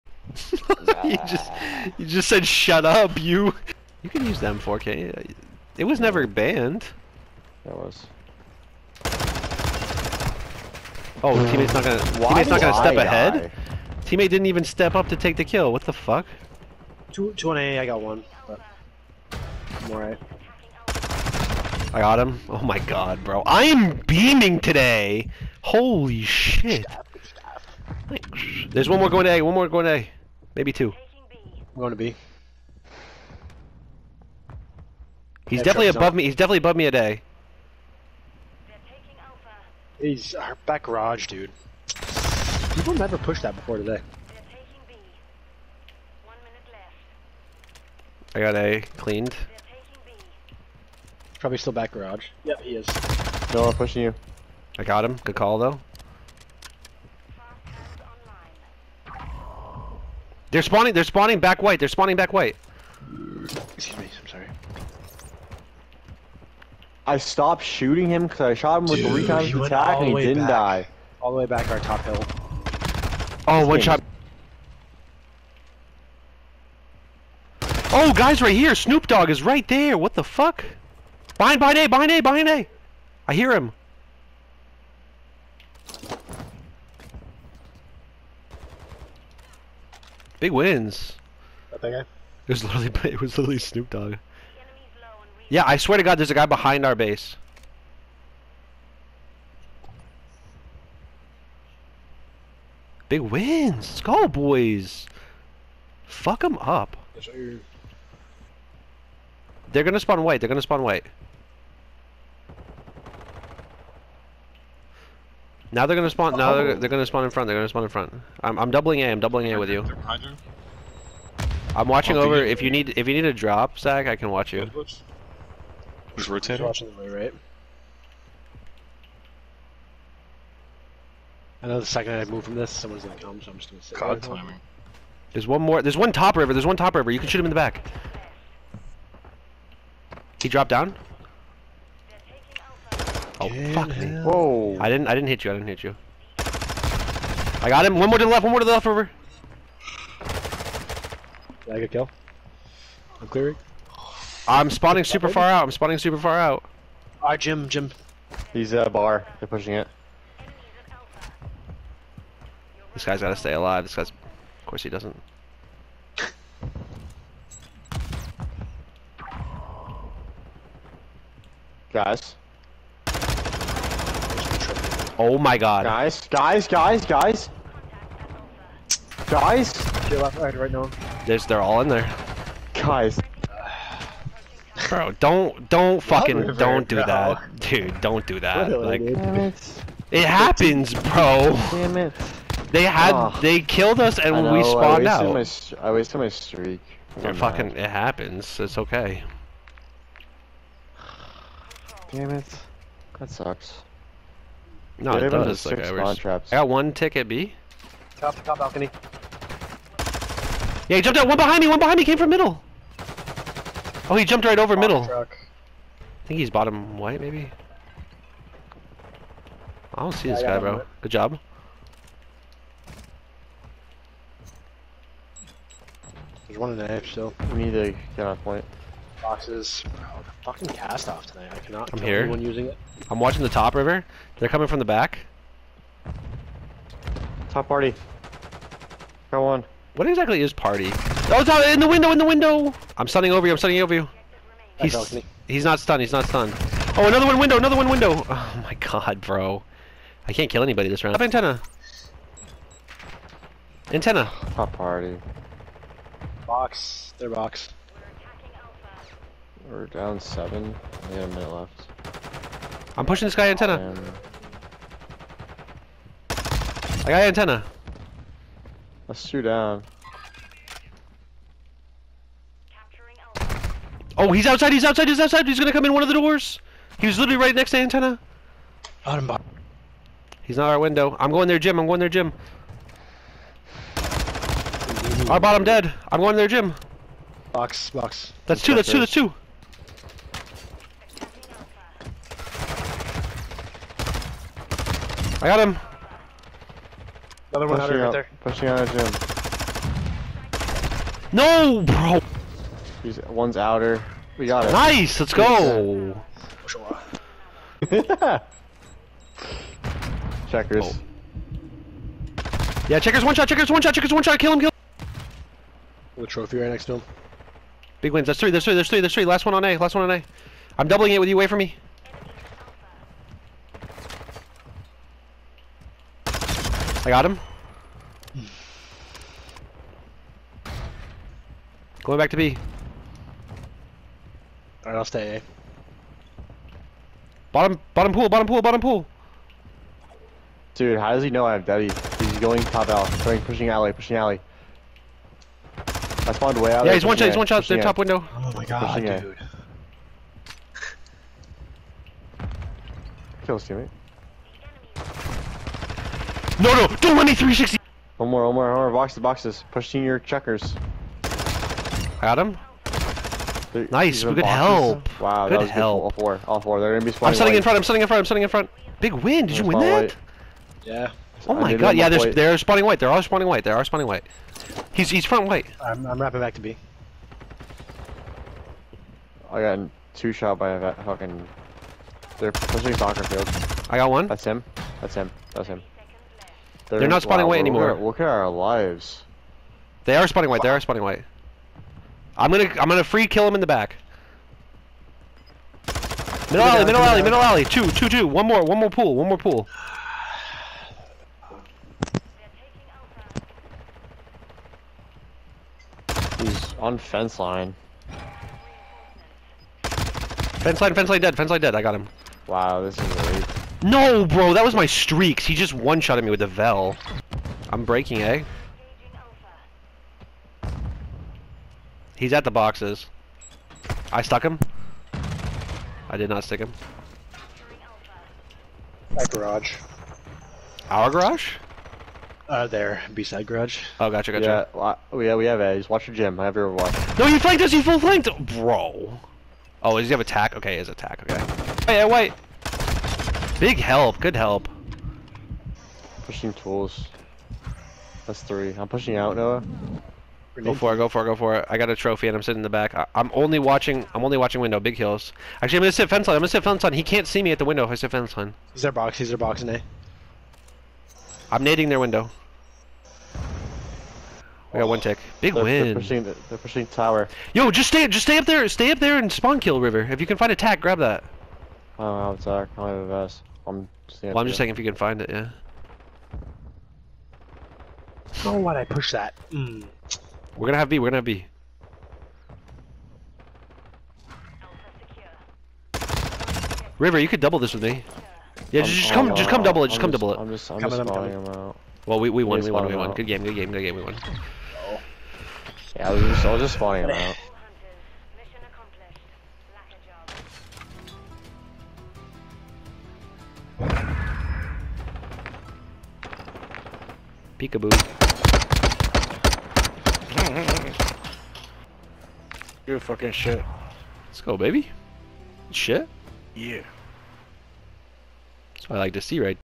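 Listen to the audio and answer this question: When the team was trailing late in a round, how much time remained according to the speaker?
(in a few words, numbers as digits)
a minute.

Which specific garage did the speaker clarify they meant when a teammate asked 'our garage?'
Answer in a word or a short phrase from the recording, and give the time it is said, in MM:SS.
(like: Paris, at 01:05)
B-side garage, at 07:13.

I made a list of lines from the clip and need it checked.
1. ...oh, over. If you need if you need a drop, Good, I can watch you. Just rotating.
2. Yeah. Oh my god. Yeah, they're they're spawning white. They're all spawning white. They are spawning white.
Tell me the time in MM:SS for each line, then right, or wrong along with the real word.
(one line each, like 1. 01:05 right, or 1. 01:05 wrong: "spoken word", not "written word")
1. 02:02 wrong: "Zach", not "Good"
2. 06:10 right.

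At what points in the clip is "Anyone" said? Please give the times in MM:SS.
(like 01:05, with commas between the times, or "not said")
03:52.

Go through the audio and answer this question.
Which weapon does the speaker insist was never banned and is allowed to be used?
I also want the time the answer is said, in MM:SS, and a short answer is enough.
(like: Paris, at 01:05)
M4K, at 00:04.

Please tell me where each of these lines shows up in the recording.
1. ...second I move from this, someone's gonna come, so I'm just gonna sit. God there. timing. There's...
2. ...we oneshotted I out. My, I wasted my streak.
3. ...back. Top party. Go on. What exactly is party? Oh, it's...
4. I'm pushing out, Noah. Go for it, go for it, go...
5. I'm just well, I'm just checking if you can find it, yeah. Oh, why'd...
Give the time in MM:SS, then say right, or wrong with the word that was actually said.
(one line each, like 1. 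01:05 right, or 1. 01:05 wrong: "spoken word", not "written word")
1. 02:11 right
2. 03:14 wrong: "spawned", not "oneshotted"
3. 03:54 right
4. 07:28 right
5. 07:53 right.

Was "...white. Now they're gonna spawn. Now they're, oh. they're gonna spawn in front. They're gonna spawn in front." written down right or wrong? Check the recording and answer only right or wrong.
right.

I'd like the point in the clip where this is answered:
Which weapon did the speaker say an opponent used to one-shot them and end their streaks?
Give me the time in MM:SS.
06:56.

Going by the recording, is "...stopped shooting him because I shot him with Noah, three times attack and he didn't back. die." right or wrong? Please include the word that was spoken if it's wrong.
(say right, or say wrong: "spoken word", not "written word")
wrong: "Dude", not "Noah".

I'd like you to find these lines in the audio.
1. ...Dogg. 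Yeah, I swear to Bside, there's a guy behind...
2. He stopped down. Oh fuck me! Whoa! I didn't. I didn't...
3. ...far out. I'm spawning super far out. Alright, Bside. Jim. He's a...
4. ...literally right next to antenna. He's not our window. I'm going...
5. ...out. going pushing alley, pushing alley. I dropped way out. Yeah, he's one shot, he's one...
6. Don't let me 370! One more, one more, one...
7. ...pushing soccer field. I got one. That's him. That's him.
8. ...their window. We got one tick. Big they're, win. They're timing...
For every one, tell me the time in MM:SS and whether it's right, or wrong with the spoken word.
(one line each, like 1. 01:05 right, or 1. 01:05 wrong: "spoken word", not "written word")
1. 01:33 wrong: "God", not "Bside"
2. 02:20 wrong: "dropped", not "stopped"
3. 02:35 wrong: "Jim", not "Bside"
4. 04:37 right
5. 05:42 wrong: "spawned", not "dropped"
6. 05:57 wrong: "360", not "370"
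7. 06:22 right
8. 07:41 wrong: "pushing", not "timing".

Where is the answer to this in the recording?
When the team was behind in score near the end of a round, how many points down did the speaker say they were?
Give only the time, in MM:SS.
04:20.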